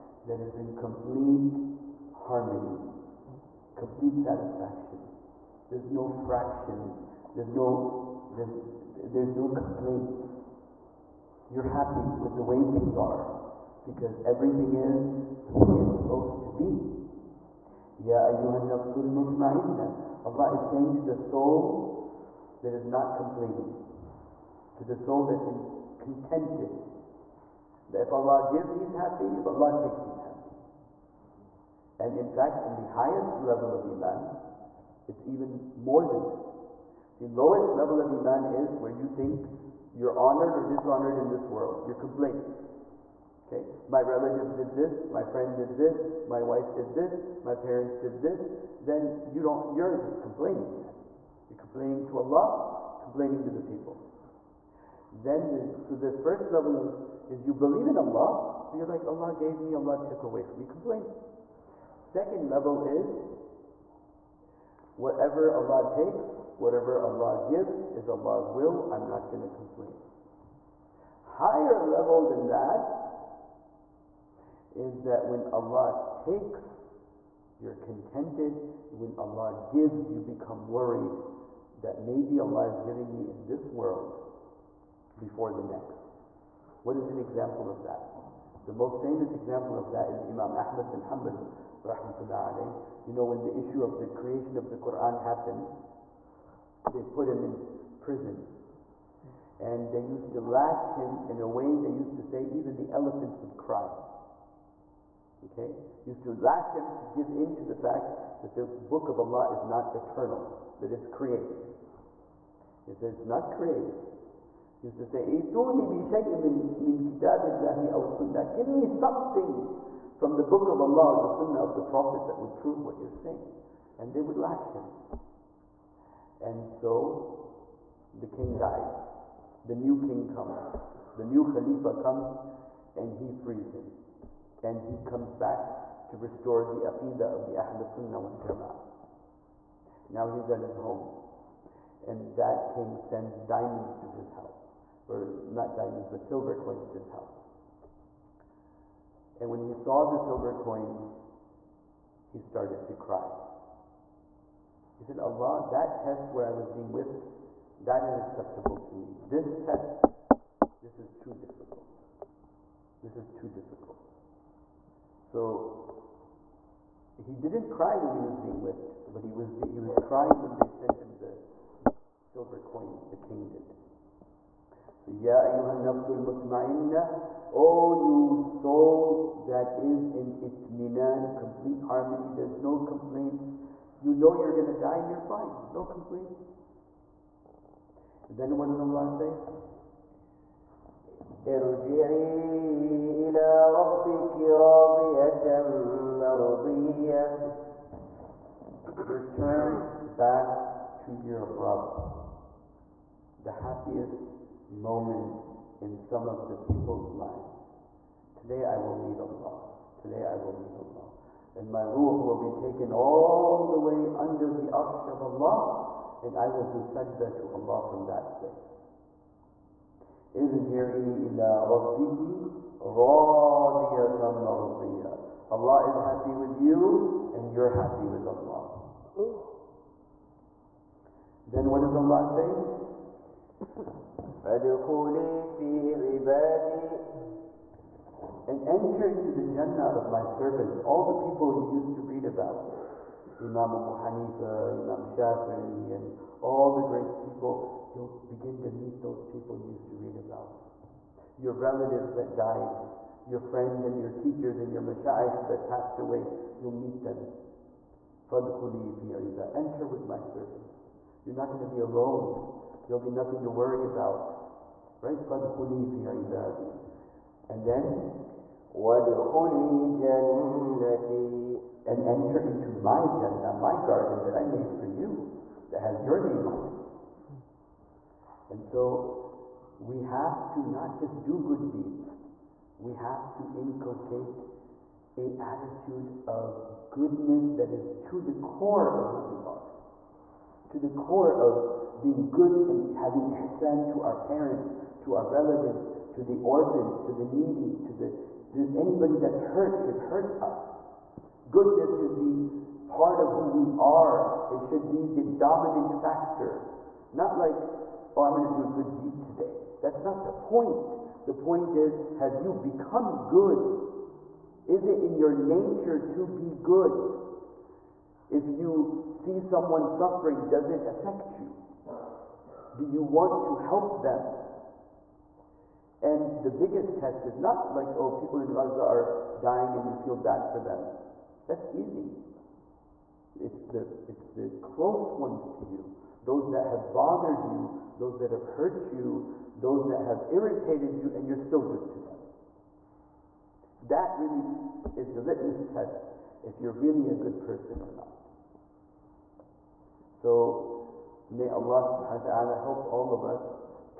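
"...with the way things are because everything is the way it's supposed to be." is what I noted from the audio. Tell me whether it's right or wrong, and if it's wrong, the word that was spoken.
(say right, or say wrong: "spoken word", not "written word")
right.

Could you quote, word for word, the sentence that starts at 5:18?
If you see someone suffering, does it affect you?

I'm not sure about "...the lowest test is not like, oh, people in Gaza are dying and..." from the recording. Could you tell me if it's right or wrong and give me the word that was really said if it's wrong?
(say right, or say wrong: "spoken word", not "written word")
wrong: "biggest", not "lowest".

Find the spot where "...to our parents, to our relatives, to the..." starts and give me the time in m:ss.
4:53.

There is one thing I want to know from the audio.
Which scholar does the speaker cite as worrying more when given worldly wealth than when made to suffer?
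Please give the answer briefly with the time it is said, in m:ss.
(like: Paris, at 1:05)
Imam Ahmad bin Hanbal, at 1:30.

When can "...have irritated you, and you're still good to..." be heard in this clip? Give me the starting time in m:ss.
5:39.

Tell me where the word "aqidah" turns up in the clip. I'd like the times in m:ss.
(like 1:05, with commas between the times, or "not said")
2:16.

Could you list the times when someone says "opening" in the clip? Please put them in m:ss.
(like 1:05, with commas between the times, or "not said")
not said.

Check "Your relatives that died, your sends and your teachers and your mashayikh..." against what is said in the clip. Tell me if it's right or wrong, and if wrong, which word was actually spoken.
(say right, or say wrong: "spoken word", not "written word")
wrong: "friends", not "sends".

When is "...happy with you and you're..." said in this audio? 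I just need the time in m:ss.
3:45.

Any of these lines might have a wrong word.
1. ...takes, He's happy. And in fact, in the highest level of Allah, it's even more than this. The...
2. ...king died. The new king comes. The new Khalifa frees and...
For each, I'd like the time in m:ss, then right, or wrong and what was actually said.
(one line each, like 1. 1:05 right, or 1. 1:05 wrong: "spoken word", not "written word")
1. 0:29 wrong: "Iman", not "Allah"
2. 2:08 wrong: "comes", not "frees".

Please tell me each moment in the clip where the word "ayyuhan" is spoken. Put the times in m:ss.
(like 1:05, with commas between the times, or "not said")
0:18, 2:55.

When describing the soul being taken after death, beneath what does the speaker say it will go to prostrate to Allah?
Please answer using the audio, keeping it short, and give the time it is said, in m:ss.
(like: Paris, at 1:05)
The arsh, at 3:34.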